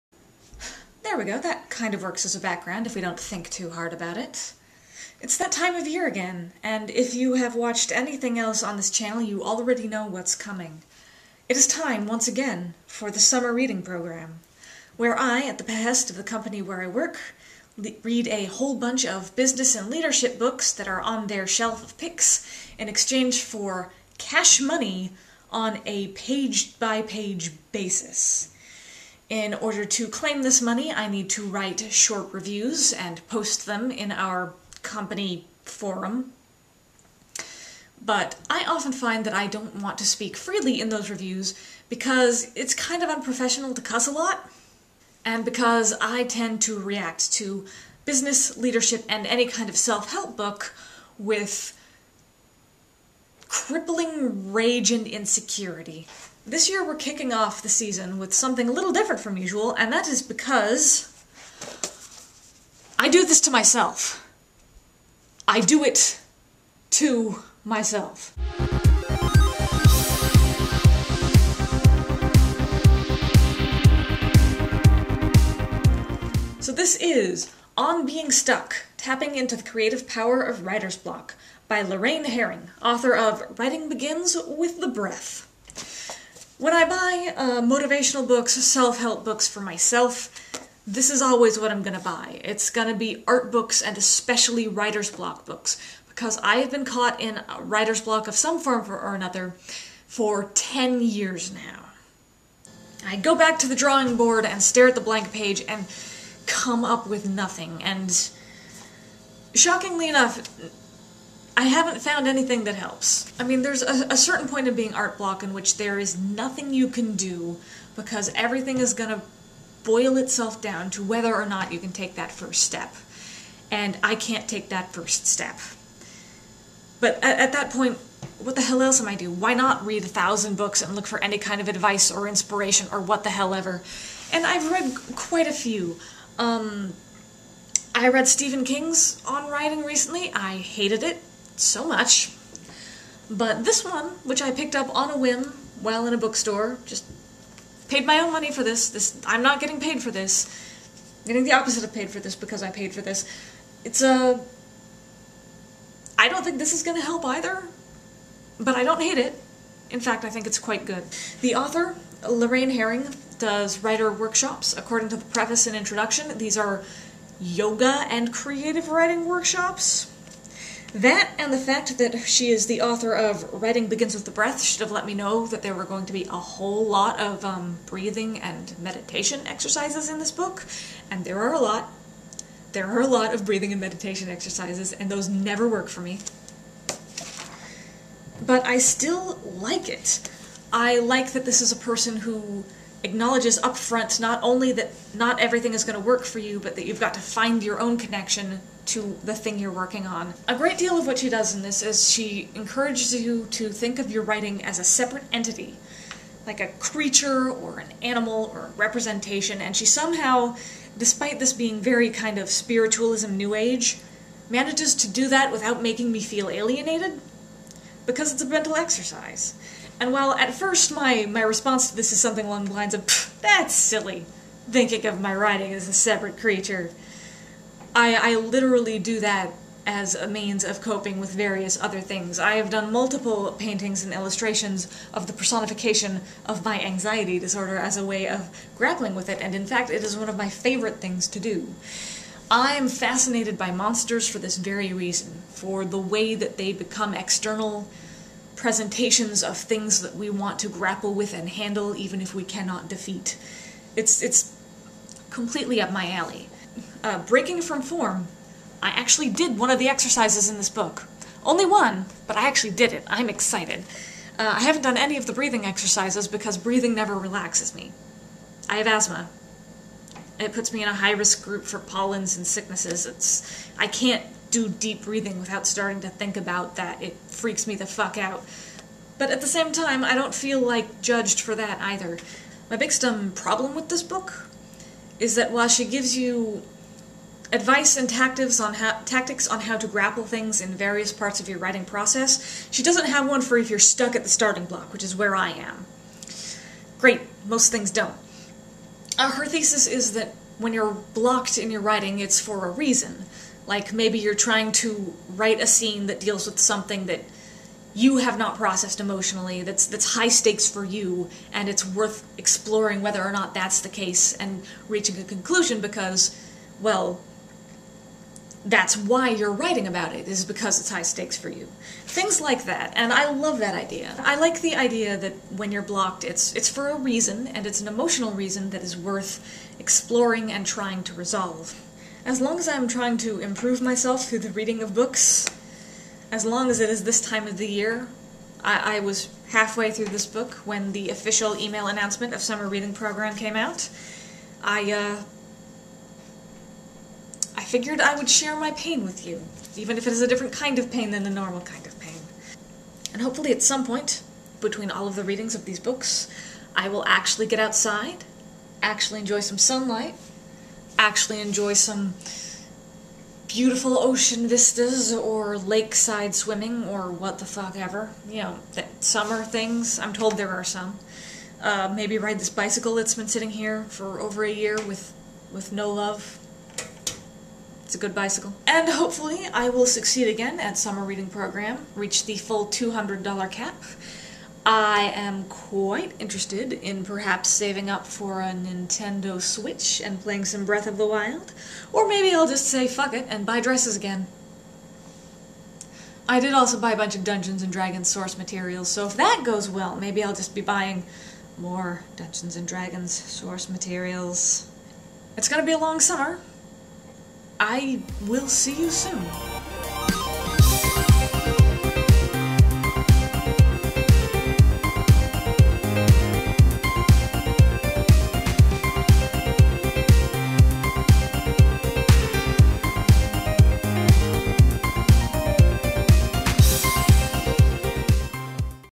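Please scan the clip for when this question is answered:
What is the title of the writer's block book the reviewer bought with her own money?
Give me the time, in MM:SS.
01:17.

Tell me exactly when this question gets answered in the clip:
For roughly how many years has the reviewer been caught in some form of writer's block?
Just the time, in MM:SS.
01:40.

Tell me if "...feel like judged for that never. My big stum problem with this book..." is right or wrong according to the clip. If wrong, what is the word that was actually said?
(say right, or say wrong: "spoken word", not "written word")
wrong: "either", not "never".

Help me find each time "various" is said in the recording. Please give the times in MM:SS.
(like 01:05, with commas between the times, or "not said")
03:51, 04:50.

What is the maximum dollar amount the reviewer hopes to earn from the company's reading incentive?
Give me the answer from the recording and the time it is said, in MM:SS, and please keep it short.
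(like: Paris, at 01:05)
$200, at 06:22.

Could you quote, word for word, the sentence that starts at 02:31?
I'm getting the opposite of paid for this because I paid for this.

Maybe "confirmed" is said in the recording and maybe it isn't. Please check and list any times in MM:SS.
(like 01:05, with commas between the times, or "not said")
not said.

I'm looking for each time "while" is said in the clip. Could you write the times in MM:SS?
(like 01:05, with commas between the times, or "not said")
02:25, 03:40, 04:45.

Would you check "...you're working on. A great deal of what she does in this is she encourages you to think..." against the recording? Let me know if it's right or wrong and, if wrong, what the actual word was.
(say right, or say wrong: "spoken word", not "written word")
right.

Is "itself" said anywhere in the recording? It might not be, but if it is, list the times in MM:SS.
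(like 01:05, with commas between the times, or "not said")
02:00.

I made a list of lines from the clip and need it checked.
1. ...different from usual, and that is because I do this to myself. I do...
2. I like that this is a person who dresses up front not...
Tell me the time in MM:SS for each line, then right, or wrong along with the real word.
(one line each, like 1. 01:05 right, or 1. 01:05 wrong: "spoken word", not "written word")
1. 00:58 right
2. 03:10 wrong: "acknowledges", not "dresses".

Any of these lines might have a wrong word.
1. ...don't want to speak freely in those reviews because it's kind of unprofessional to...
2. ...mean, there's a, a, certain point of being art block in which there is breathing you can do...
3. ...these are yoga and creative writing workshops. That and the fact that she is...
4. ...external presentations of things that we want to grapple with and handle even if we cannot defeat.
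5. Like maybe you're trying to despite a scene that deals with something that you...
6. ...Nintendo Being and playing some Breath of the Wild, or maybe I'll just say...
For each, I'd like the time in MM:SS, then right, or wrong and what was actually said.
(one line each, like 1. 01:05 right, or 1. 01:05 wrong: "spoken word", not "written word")
1. 00:39 right
2. 01:53 wrong: "nothing", not "breathing"
3. 02:46 right
4. 04:07 right
5. 05:03 wrong: "write", not "despite"
6. 06:28 wrong: "Switch", not "Being".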